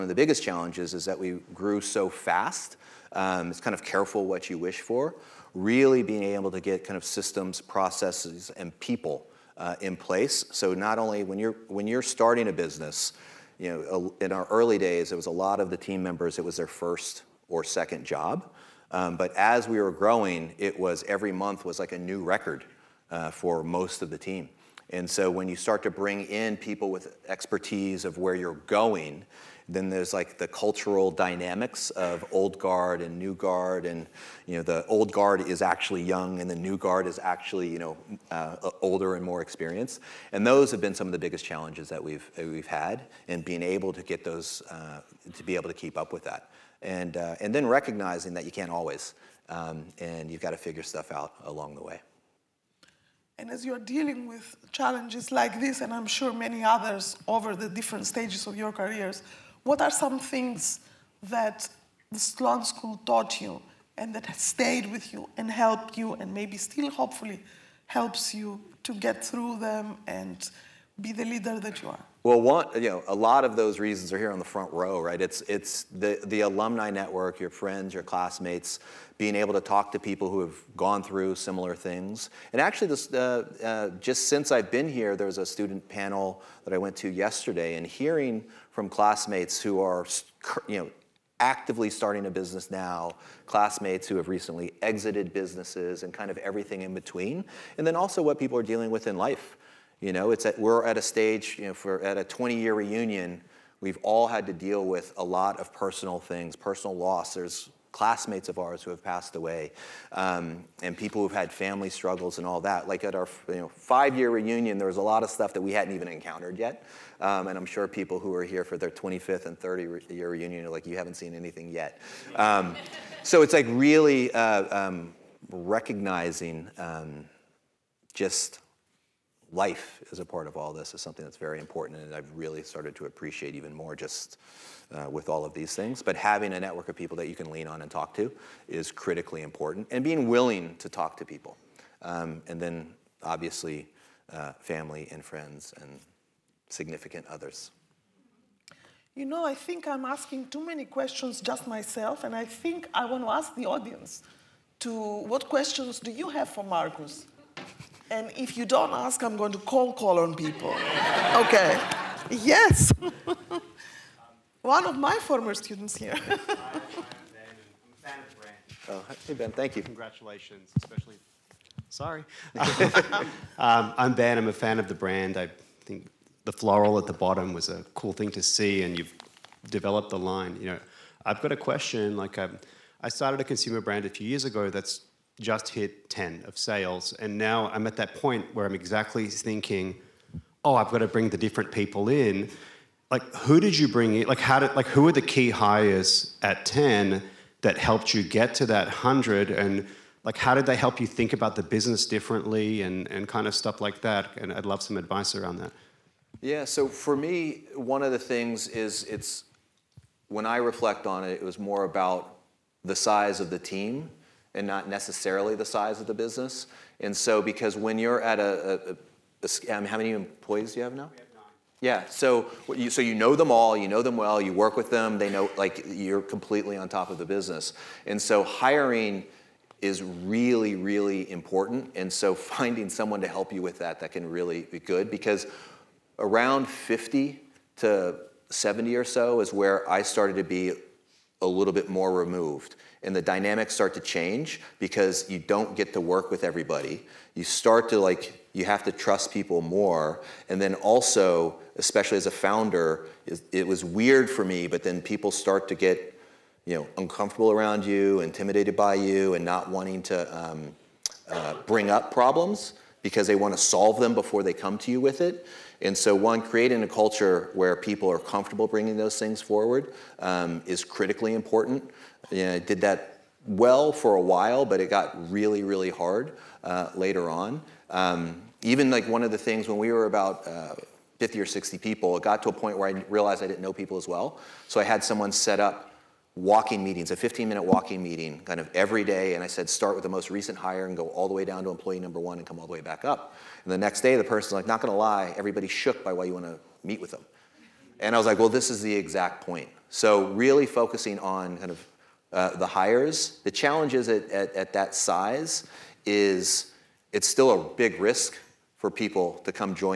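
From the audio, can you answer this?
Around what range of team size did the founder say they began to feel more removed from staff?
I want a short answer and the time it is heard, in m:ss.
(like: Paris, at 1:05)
50 to 70, at 3:56.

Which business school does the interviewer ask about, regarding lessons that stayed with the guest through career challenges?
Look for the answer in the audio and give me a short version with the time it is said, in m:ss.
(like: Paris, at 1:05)
Sloan School, at 1:02.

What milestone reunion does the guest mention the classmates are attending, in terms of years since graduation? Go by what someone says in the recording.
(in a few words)
20-year reunion.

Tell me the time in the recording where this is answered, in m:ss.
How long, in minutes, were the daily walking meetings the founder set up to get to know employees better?
4:47.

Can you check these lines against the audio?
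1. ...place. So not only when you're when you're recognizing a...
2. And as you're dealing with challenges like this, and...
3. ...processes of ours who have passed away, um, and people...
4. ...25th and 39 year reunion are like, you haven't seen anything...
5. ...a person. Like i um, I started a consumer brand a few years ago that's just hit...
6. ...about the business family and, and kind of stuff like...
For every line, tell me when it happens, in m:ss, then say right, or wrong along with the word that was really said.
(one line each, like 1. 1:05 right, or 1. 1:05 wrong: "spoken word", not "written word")
1. 0:09 wrong: "starting", not "recognizing"
2. 0:53 right
3. 1:47 wrong: "classmates", not "processes"
4. 1:58 wrong: "30", not "39"
5. 3:01 wrong: "question", not "person"
6. 3:21 wrong: "differently", not "family".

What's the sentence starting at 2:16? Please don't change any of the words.
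But having a network of people that you can lean on and talk to is critically important.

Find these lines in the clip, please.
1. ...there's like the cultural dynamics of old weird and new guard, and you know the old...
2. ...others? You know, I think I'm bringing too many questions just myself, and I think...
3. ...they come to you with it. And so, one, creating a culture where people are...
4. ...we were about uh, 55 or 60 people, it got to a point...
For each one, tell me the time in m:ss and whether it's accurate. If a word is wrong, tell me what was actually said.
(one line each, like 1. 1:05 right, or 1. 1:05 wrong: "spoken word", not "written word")
1. 0:29 wrong: "guard", not "weird"
2. 2:27 wrong: "asking", not "bringing"
3. 4:24 right
4. 4:39 wrong: "50", not "55".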